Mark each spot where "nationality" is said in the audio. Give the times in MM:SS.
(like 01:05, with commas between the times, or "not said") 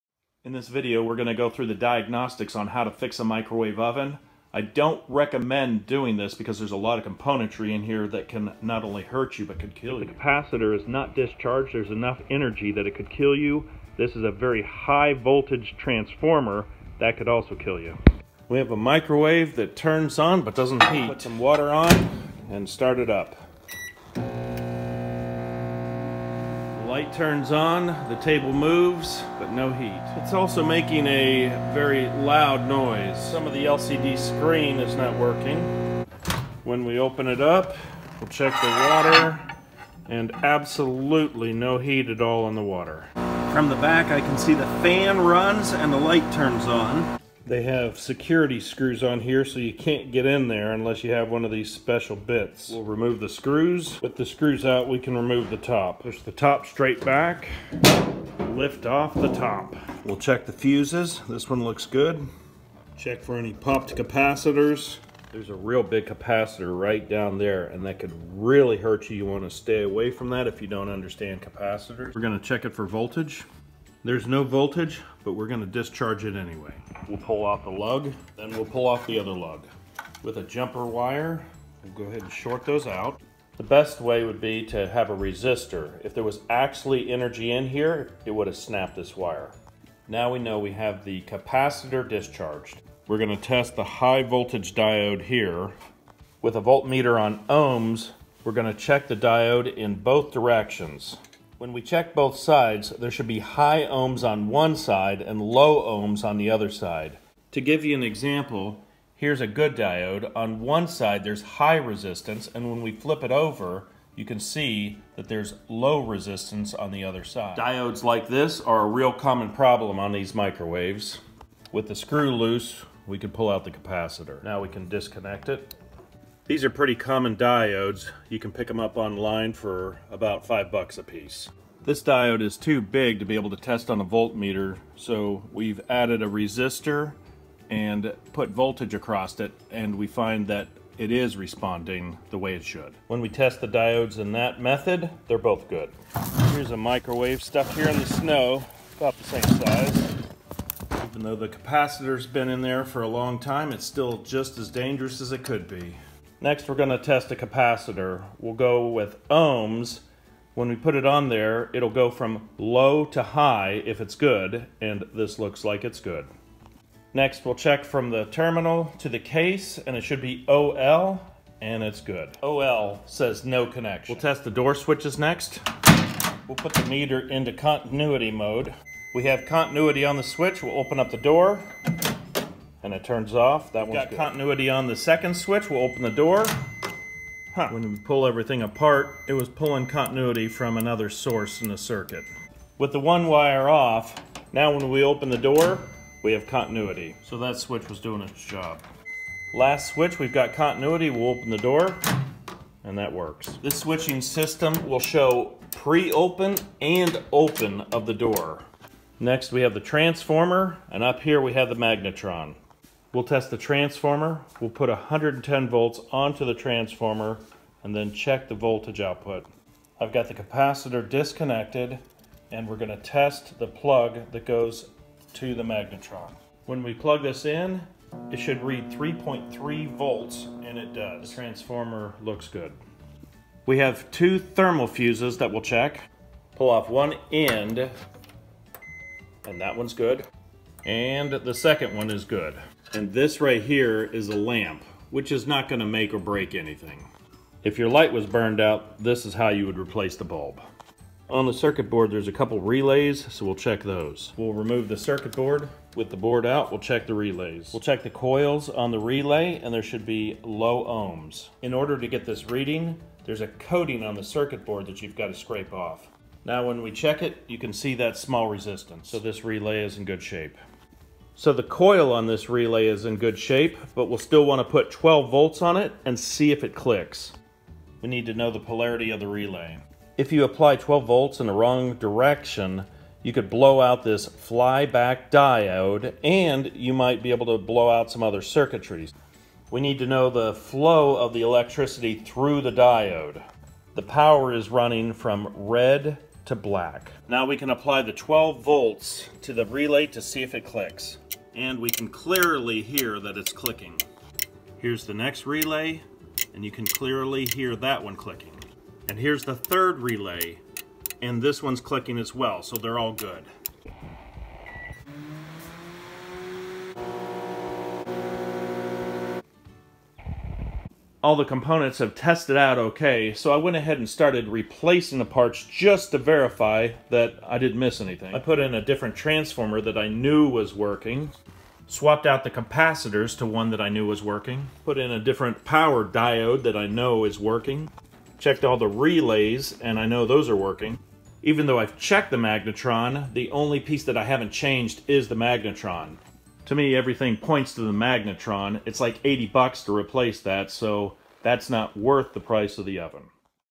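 not said.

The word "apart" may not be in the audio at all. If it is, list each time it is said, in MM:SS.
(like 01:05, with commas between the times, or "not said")
03:08.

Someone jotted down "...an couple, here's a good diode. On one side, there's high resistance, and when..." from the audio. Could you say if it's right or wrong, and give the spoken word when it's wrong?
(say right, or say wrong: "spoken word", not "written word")
wrong: "example", not "couple".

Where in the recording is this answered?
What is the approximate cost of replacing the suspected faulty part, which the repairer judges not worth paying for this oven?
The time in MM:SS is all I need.
05:49.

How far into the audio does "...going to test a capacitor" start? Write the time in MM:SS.
02:36.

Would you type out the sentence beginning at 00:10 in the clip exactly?
If the capacitor is not discharged.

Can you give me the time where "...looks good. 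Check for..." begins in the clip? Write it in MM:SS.
01:01.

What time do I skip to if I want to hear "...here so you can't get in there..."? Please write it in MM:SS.
00:49.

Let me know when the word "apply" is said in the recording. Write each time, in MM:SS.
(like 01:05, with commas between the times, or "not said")
04:40, 04:57.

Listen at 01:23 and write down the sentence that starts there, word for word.
The best way would be to have a resistor.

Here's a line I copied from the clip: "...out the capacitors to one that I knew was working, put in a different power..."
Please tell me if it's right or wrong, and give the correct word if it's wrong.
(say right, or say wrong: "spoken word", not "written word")
right.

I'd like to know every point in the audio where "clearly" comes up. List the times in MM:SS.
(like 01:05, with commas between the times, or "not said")
05:02, 05:06.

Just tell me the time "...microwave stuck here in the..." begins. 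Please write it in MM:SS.
02:26.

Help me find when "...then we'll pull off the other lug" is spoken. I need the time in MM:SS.
01:18.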